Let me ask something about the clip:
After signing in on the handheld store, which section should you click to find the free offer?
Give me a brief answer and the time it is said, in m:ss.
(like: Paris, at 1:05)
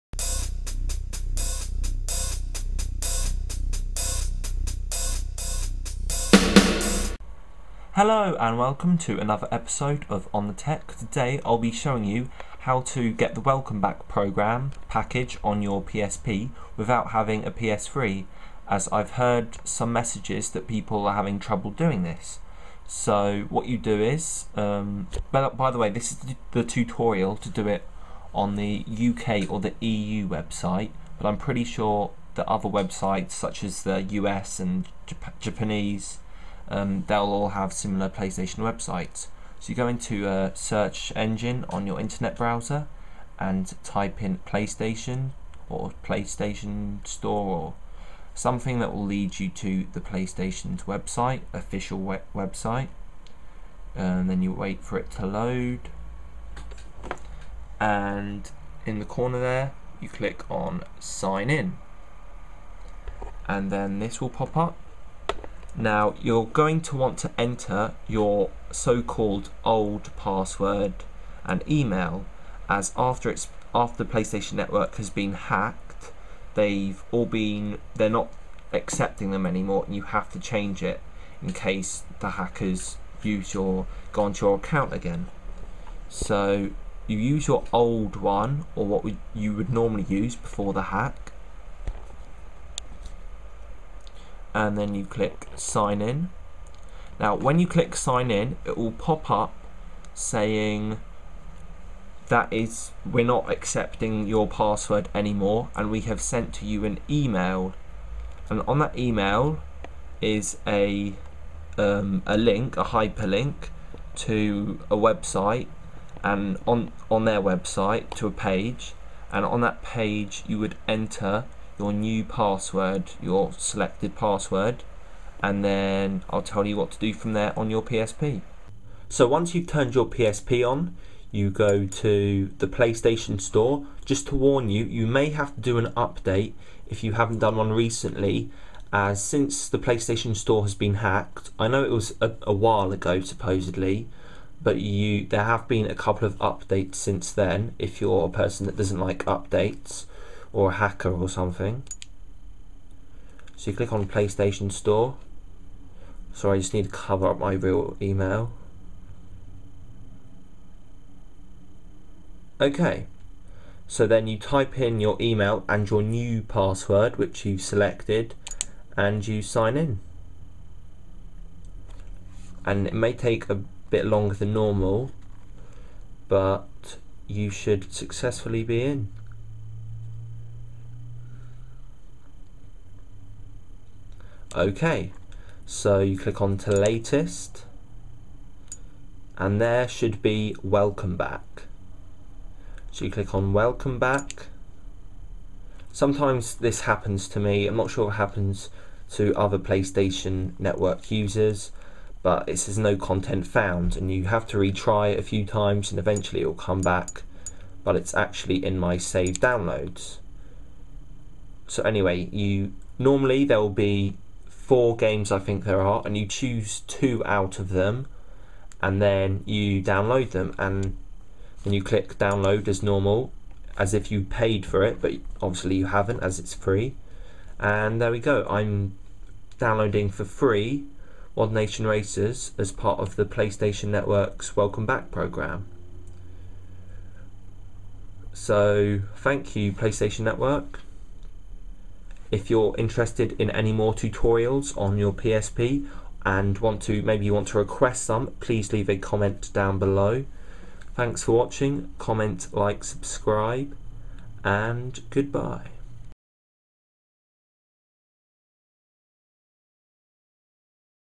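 Latest, at 3:06.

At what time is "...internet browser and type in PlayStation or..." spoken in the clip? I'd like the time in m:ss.
0:41.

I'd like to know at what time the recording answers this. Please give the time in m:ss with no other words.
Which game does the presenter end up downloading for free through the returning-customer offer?
3:51.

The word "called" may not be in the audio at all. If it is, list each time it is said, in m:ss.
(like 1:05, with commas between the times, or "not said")
1:08.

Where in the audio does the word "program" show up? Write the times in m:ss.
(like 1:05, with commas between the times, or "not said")
0:14, 3:55.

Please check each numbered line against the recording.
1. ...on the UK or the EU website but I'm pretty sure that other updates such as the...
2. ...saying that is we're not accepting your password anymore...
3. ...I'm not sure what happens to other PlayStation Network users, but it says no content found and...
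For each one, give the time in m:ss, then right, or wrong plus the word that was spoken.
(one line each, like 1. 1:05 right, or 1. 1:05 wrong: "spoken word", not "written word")
1. 0:28 wrong: "websites", not "updates"
2. 1:40 right
3. 3:17 right.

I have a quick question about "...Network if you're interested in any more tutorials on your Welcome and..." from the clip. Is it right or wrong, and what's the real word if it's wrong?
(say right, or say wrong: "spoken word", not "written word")
wrong: "PSP", not "Welcome".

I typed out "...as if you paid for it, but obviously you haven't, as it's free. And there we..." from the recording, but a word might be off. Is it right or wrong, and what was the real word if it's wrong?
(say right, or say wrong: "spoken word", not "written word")
right.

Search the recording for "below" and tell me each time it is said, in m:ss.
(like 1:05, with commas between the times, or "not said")
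4:09.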